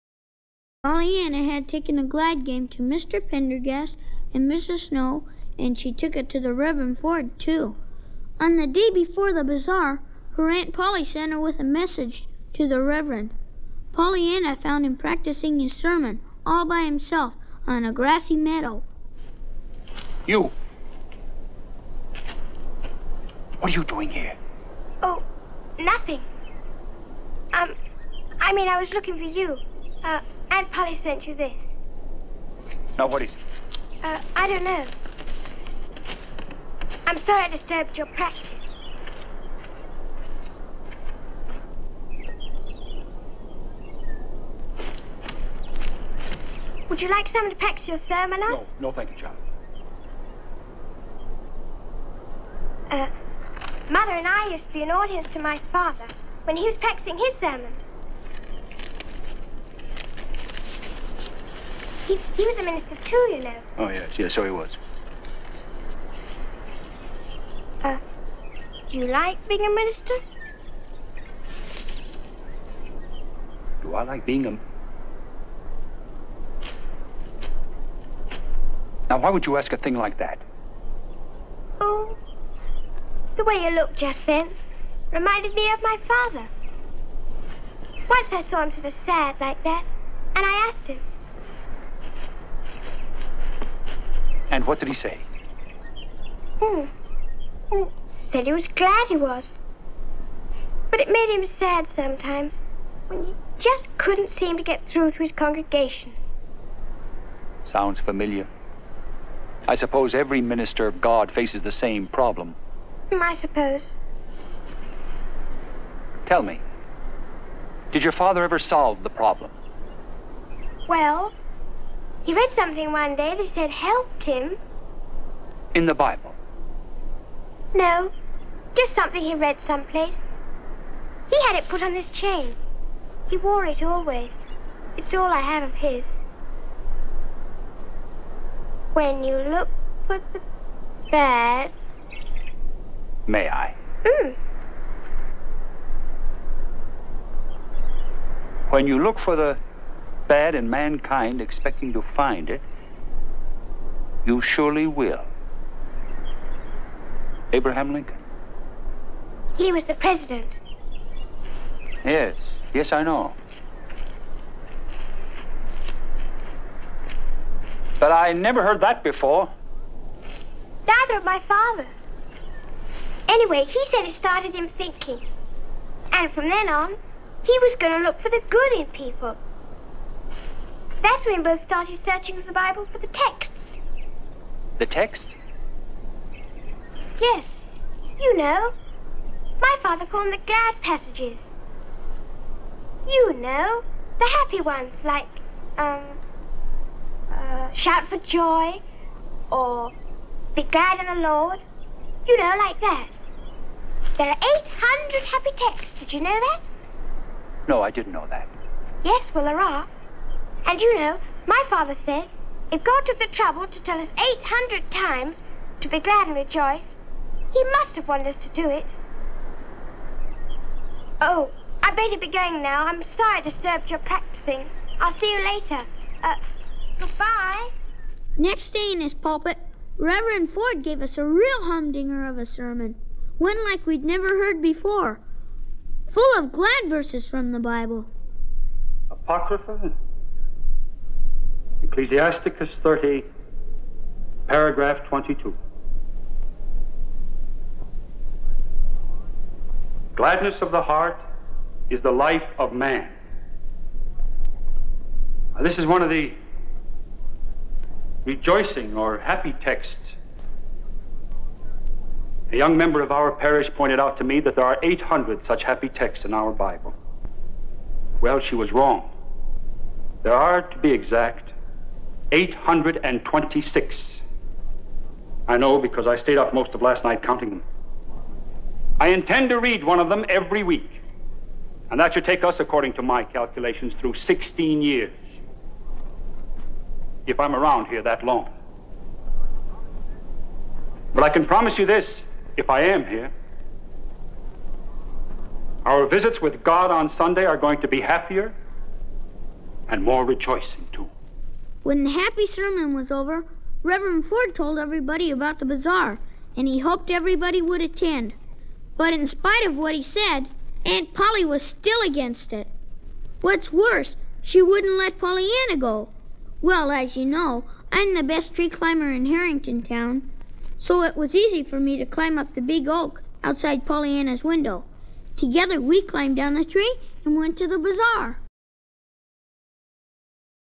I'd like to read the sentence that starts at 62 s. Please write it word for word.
He, was a minister too, you know.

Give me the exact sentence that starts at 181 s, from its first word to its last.
That's when both started searching for the Bible for the texts.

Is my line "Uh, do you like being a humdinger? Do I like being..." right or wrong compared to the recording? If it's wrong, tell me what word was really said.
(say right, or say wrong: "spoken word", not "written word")
wrong: "minister", not "humdinger".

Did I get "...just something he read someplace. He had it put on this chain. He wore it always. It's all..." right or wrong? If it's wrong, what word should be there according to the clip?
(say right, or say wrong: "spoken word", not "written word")
right.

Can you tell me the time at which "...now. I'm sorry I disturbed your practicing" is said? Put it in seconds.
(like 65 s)
222 s.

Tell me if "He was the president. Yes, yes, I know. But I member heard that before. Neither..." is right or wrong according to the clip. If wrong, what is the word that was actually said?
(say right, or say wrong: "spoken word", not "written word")
wrong: "never", not "member".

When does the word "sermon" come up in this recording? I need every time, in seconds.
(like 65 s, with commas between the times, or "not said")
15 s, 47 s, 57 s, 232 s, 302 s.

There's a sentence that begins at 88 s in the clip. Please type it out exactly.
Once I saw him sort of sad like that, and I asked him.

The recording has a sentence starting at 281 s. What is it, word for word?
And that should take us, according to my calculations, through 16 years.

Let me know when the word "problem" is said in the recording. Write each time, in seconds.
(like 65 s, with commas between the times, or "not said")
112 s, 119 s.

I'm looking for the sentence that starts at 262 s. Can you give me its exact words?
A young member of our parish pointed out to me that there are 800 such happy texts in our Bible.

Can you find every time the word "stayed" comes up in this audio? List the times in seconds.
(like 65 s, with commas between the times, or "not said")
276 s.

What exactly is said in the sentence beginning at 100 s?
But it made him sad sometimes when he just couldn't seem to get through to his congregation.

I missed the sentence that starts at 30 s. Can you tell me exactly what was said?
Uh, Aunt Polly sent you this.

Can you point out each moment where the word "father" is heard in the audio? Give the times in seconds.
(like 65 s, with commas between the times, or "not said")
55 s, 86 s, 118 s, 171 s, 189 s, 211 s.